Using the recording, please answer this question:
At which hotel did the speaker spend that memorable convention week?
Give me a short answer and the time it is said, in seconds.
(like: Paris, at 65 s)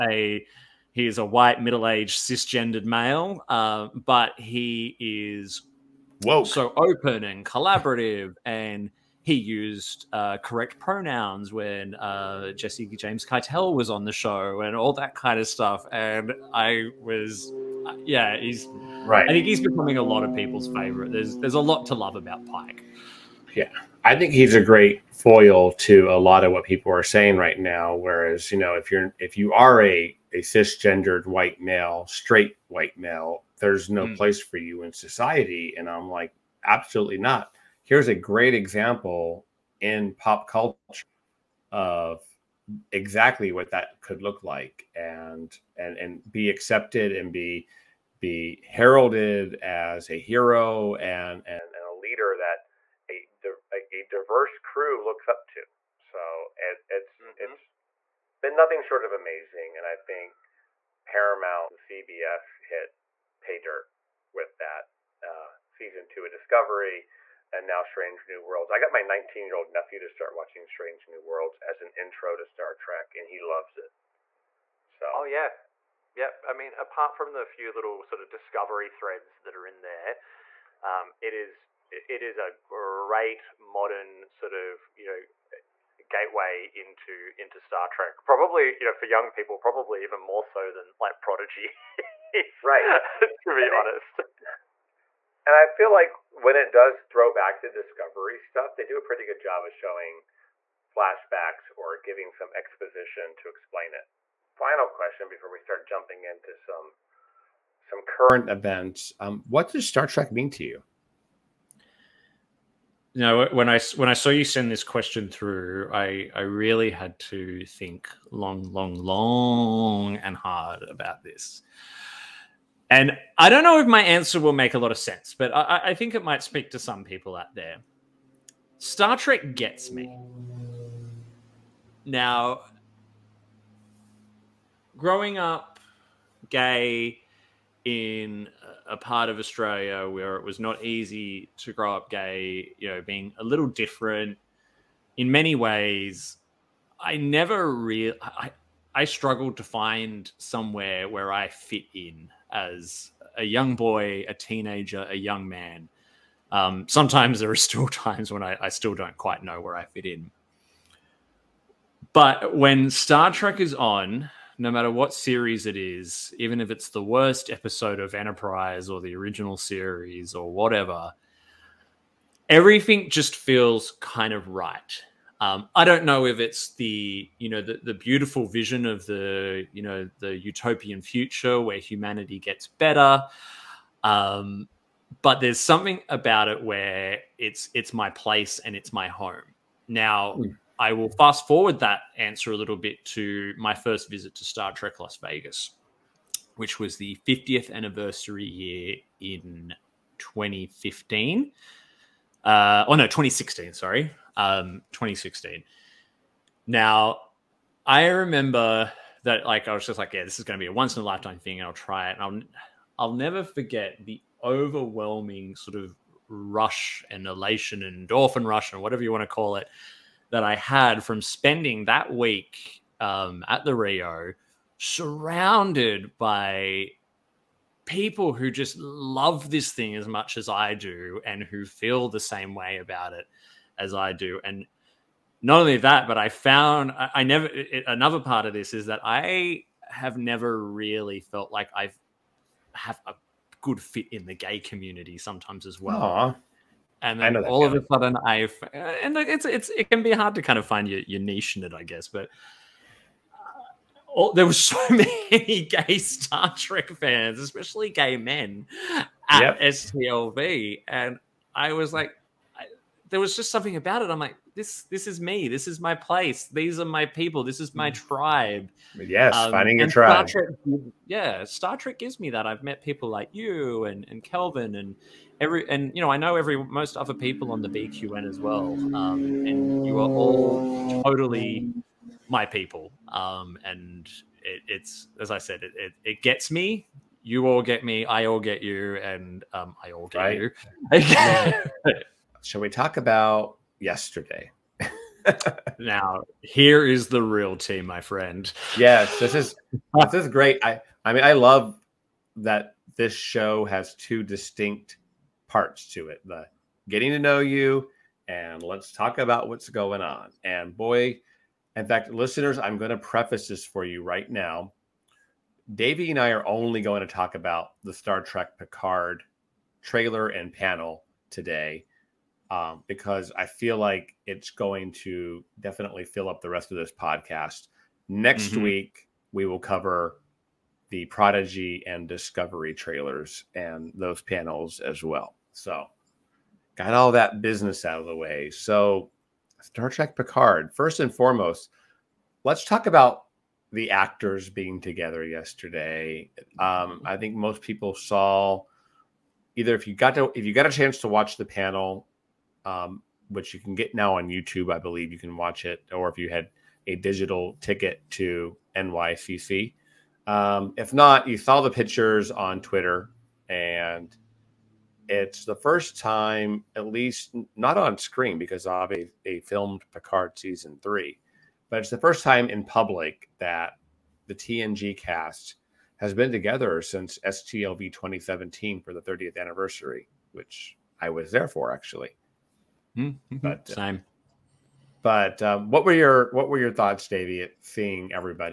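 the Rio, at 223 s.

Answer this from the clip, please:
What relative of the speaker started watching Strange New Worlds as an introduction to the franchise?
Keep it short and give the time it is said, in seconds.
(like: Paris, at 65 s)
nephew, at 69 s.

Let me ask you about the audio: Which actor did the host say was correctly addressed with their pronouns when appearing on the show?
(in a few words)
Jesse James Keitel.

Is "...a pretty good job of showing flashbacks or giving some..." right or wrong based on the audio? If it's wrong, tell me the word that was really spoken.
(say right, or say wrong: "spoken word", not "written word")
right.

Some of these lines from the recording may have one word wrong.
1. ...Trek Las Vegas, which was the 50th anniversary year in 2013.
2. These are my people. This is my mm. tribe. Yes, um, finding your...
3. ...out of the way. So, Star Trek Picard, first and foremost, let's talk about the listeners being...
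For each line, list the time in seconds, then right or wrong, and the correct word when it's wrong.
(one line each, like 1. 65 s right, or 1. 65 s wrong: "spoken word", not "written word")
1. 194 s wrong: "2015", not "2013"
2. 266 s right
3. 337 s wrong: "actors", not "listeners".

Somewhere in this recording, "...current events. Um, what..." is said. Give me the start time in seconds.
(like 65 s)
108 s.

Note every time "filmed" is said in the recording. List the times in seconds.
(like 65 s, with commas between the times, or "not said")
369 s.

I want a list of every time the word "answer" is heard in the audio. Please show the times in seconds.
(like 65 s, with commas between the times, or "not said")
124 s, 192 s.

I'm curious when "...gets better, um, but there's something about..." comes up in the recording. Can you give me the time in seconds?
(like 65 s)
182 s.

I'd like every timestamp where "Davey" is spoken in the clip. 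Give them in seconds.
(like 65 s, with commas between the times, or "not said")
315 s, 387 s.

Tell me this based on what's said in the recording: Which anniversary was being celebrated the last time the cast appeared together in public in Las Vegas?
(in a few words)
30th anniversary.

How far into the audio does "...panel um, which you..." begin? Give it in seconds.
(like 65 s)
351 s.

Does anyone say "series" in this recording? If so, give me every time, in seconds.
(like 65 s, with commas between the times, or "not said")
165 s, 169 s.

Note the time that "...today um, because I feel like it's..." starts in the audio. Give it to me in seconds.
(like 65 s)
321 s.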